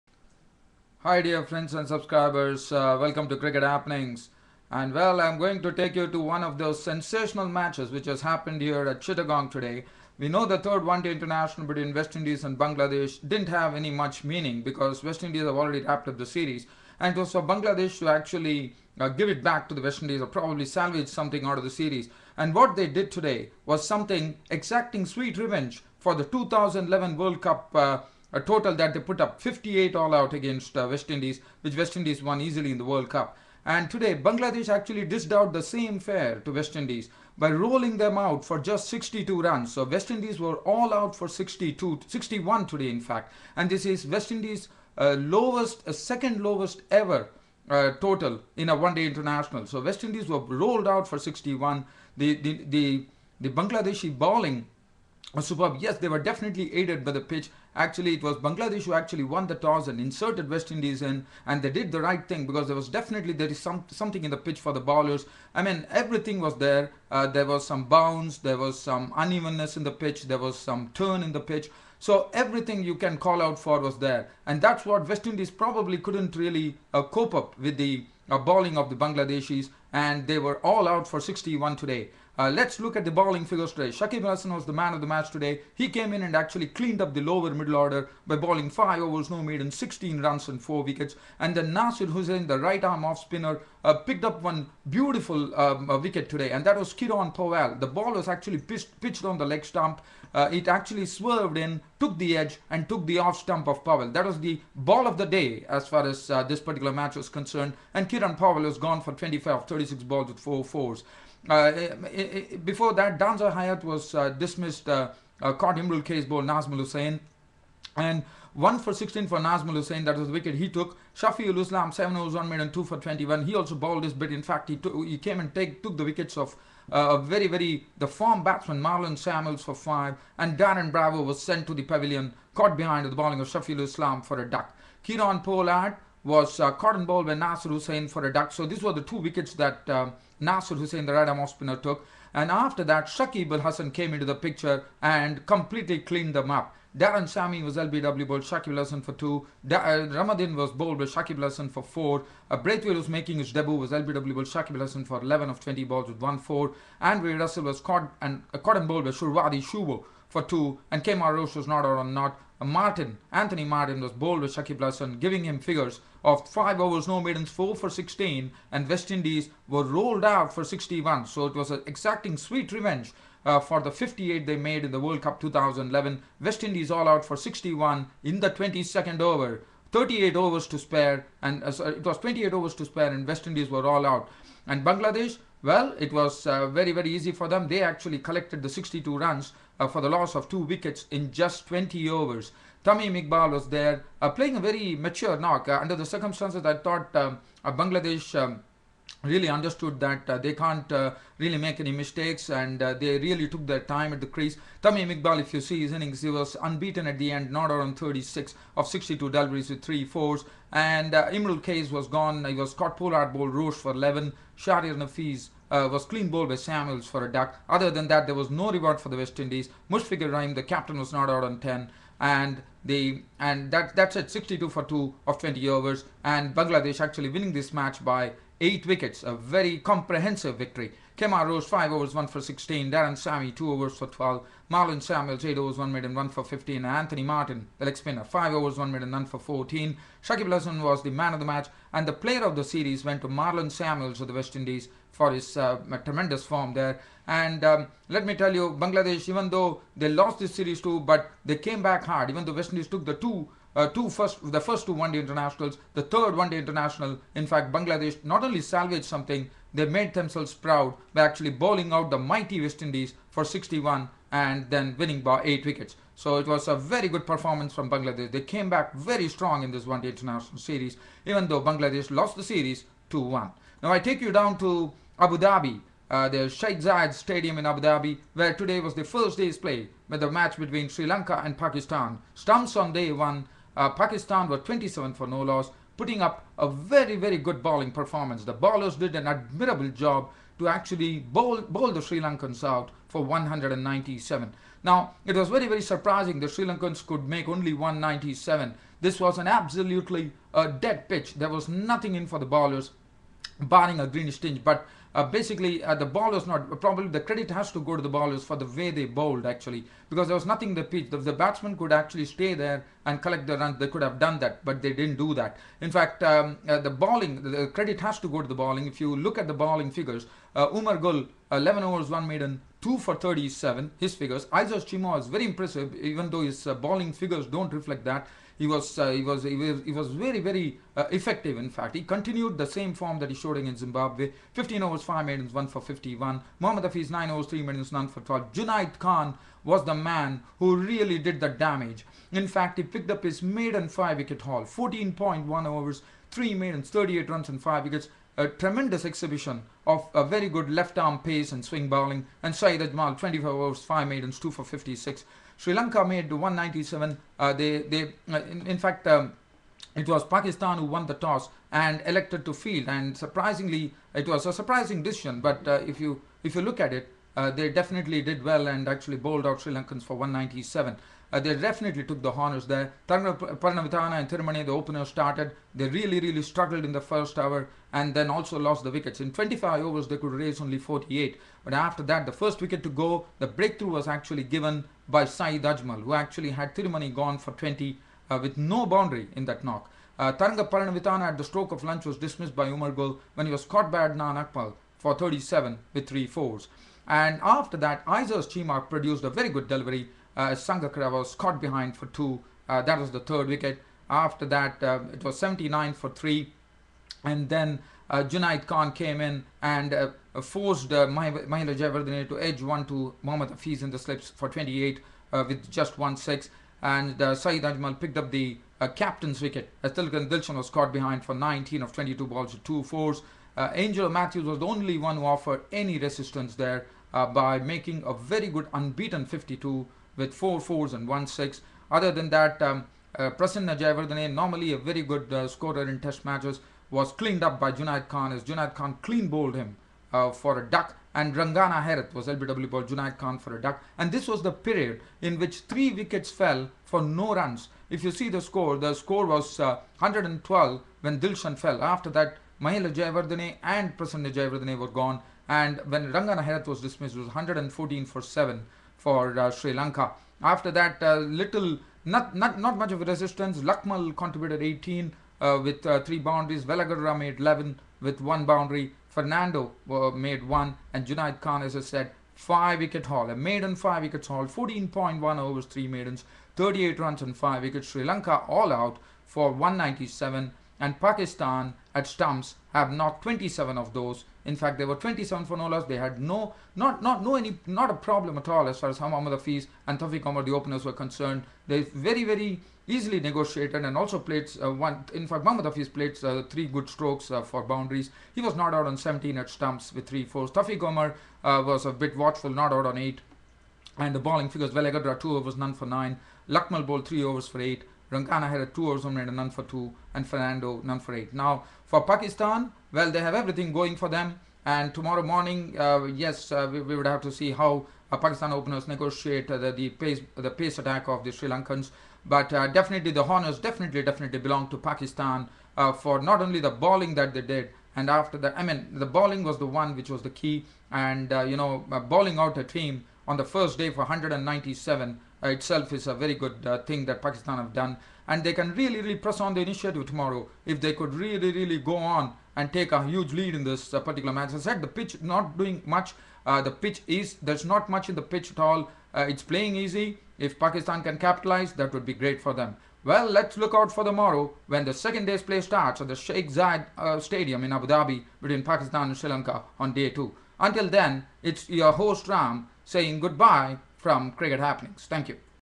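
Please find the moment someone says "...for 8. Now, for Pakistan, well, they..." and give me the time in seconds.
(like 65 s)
510 s.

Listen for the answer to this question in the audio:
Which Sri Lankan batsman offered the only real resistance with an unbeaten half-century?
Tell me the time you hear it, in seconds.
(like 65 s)
423 s.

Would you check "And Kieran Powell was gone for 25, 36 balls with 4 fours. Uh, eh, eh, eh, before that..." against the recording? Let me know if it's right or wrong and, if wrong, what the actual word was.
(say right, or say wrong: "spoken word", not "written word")
right.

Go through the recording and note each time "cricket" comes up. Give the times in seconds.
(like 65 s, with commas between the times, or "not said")
3 s, 564 s.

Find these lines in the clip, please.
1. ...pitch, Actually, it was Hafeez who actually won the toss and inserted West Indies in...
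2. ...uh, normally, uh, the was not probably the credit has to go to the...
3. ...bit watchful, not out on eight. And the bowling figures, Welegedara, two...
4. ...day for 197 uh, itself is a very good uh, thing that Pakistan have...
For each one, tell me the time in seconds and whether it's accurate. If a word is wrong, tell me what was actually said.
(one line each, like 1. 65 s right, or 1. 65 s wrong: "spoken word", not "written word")
1. 57 s wrong: "Bangladesh", not "Hafeez"
2. 305 s wrong: "basically", not "normally"
3. 501 s right
4. 533 s right.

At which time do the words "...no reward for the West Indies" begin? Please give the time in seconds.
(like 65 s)
218 s.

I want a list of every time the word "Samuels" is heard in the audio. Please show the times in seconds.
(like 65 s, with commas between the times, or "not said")
129 s, 216 s, 235 s, 243 s.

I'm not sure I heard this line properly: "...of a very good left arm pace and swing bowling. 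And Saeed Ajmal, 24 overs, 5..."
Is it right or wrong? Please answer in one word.
right.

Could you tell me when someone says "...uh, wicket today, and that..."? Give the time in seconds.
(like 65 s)
95 s.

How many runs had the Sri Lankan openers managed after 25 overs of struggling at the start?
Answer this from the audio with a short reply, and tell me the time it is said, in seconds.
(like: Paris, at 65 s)
48, at 380 s.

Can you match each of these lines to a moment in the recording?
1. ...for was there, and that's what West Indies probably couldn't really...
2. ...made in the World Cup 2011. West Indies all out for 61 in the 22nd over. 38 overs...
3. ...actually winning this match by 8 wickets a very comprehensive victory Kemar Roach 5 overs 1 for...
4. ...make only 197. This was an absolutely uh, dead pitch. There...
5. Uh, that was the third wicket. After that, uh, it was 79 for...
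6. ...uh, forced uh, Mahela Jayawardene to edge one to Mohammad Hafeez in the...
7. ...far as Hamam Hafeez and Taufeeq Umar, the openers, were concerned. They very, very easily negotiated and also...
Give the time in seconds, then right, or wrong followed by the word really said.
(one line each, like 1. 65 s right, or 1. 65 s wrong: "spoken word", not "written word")
1. 73 s right
2. 174 s right
3. 227 s right
4. 297 s right
5. 402 s right
6. 409 s right
7. 488 s right.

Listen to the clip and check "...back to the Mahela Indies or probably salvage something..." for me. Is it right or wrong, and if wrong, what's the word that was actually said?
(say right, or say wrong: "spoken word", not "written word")
wrong: "West", not "Mahela".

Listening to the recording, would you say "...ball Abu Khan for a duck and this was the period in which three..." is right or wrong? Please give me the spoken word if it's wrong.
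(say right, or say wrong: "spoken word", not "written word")
wrong: "Junaid", not "Abu".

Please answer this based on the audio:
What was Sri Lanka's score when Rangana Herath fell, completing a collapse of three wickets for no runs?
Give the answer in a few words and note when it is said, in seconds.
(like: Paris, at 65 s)
114 for 7, at 457 s.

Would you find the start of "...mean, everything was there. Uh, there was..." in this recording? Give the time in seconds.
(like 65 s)
65 s.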